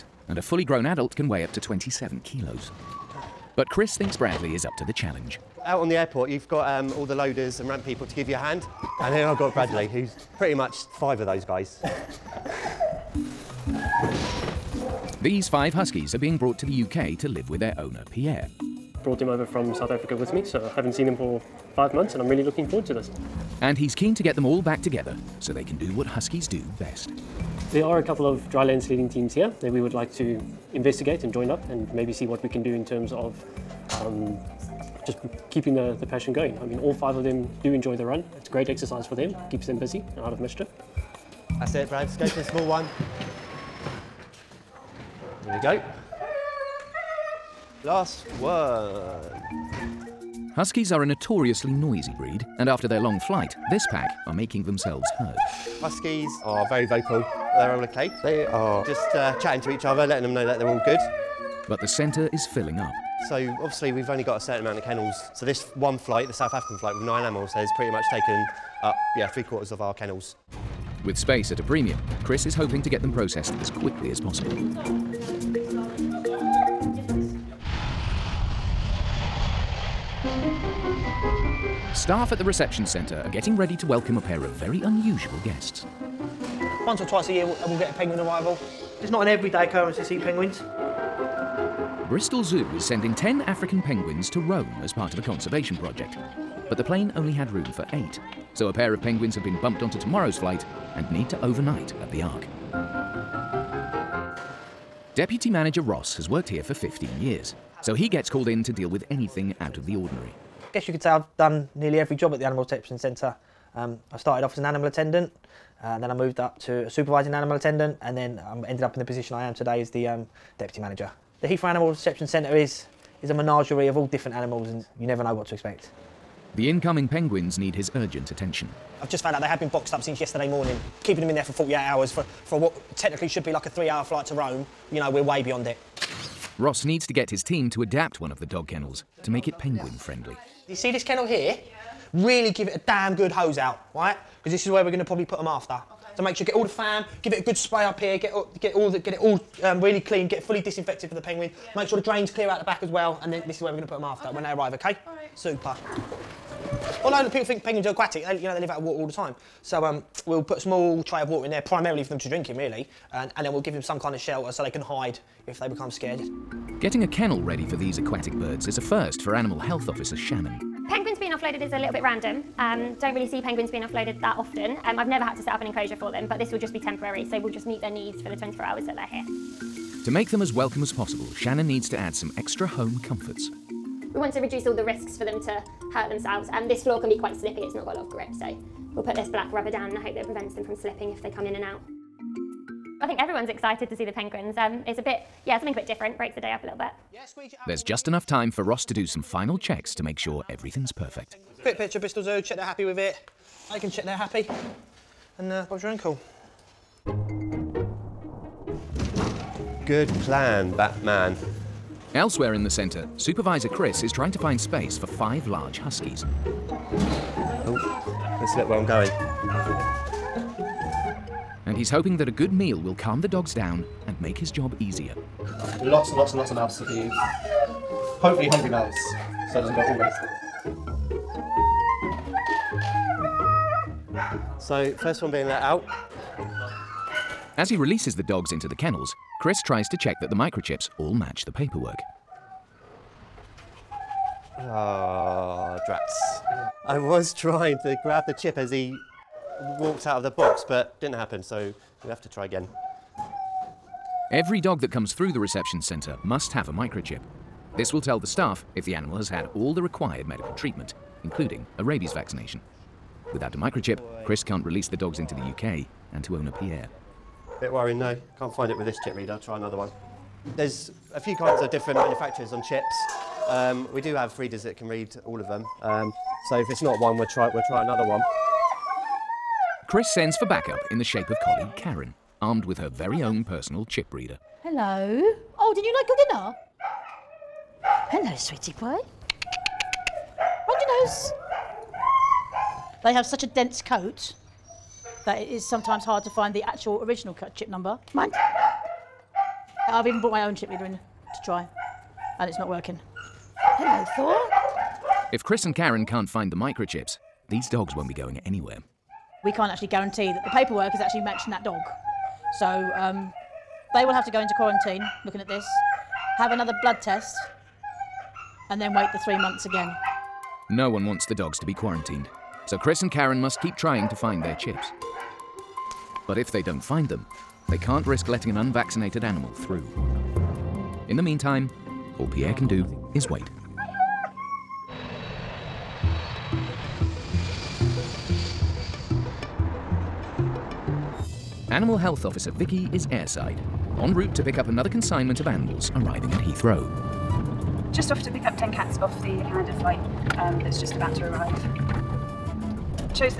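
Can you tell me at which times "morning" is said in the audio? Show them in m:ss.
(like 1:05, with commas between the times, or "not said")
2:10.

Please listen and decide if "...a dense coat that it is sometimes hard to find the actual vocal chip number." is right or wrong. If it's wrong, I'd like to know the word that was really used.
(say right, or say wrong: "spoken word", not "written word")
wrong: "original", not "vocal".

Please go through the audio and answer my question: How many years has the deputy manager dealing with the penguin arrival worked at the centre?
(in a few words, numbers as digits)
15.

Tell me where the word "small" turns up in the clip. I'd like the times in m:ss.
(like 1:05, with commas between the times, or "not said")
0:42, 2:40.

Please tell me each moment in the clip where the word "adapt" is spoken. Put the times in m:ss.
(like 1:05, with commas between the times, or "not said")
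2:17.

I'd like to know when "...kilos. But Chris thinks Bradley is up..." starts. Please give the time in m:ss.
0:02.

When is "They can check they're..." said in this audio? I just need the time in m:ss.
3:23.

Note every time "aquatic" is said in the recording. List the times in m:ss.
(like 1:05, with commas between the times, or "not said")
2:37, 2:47.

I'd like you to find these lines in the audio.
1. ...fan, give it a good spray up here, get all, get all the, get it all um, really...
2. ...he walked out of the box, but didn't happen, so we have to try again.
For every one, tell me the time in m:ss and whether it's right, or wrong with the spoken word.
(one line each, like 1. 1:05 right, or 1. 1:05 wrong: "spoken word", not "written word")
1. 2:26 right
2. 4:08 right.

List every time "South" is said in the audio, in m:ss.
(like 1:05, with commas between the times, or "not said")
0:19, 1:06.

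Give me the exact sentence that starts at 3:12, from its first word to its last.
I think everyone's excited to see the penguins.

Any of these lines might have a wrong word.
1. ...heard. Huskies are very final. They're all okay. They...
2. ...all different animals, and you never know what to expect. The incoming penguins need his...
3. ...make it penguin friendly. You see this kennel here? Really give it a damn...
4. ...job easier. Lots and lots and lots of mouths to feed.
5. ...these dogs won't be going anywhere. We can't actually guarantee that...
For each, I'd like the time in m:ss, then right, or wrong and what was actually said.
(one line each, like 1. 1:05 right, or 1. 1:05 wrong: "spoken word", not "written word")
1. 0:55 wrong: "vocal", not "final"
2. 2:03 right
3. 2:19 right
4. 3:44 right
5. 5:07 right.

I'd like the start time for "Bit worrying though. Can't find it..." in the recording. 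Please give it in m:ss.
4:27.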